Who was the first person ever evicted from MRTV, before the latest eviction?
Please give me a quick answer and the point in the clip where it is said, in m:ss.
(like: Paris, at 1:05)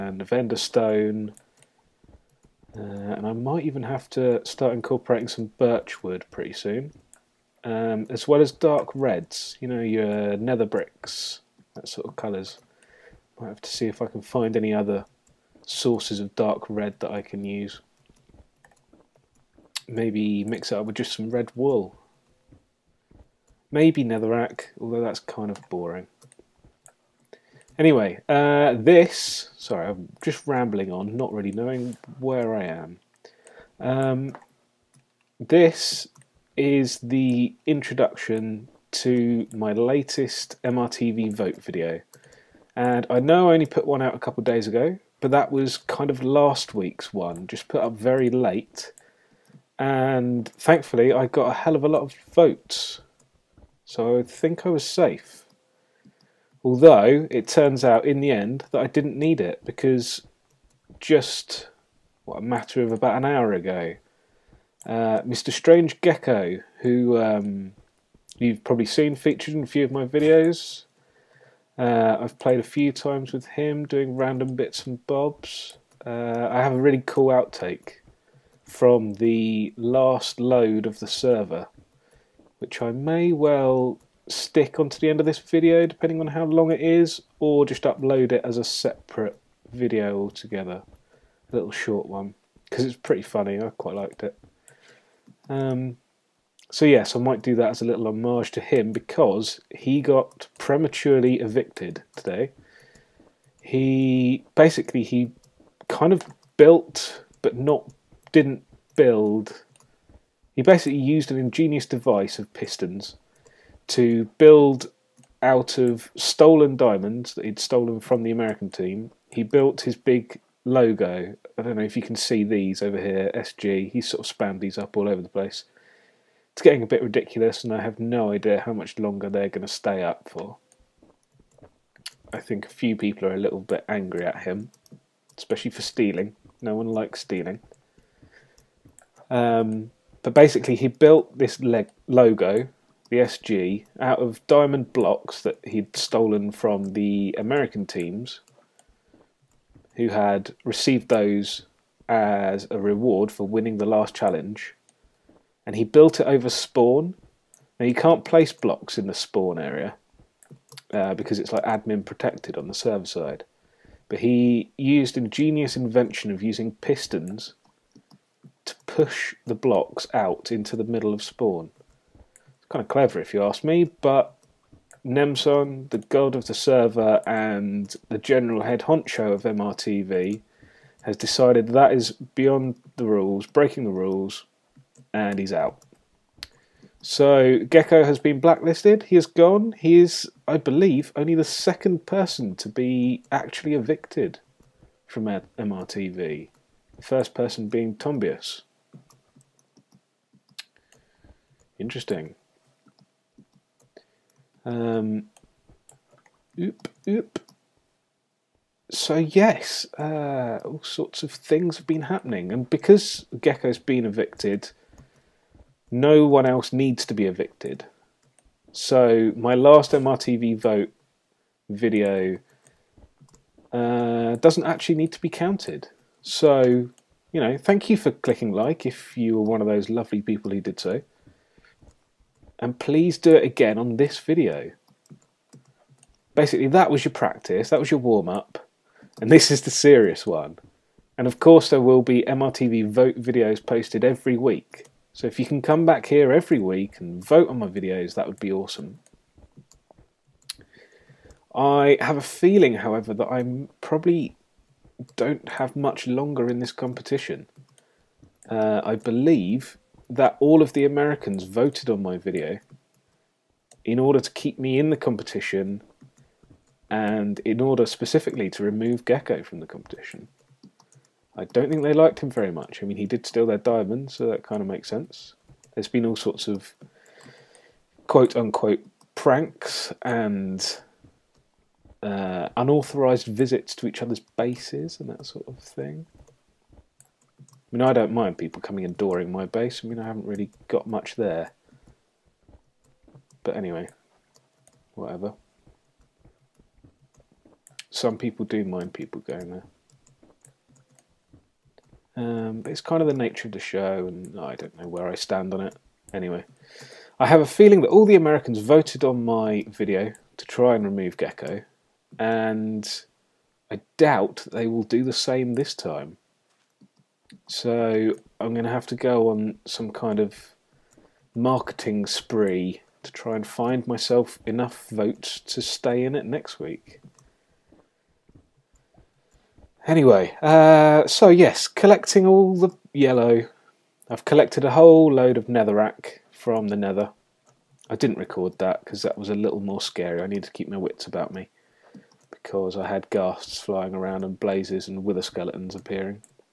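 Tombius, at 3:17.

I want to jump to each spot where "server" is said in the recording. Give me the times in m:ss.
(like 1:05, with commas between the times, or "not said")
1:21, 2:42, 2:56.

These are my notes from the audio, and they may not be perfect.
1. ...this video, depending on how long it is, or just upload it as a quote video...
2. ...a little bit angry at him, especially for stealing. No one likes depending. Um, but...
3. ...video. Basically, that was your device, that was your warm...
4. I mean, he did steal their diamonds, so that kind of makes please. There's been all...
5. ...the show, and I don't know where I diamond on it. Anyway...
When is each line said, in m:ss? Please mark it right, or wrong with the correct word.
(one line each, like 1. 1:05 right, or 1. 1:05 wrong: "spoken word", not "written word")
1. 1:25 wrong: "separate", not "quote"
2. 2:13 wrong: "stealing", not "depending"
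3. 3:54 wrong: "practice", not "device"
4. 4:32 wrong: "sense", not "please"
5. 5:03 wrong: "stand", not "diamond".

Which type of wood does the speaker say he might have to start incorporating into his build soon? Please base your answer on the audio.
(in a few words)
Birch wood.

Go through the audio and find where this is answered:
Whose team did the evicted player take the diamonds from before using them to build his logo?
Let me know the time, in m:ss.
1:58.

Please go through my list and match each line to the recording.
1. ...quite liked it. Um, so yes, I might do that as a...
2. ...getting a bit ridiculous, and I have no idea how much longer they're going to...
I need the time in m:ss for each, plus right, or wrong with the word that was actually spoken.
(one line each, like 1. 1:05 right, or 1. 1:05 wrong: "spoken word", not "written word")
1. 1:33 right
2. 2:06 right.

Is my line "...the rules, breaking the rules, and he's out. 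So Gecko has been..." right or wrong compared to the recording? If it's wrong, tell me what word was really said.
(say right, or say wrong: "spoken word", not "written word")
right.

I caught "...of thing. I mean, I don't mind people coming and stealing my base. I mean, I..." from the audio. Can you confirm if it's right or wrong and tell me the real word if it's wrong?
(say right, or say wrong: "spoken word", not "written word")
wrong: "dooring", not "stealing".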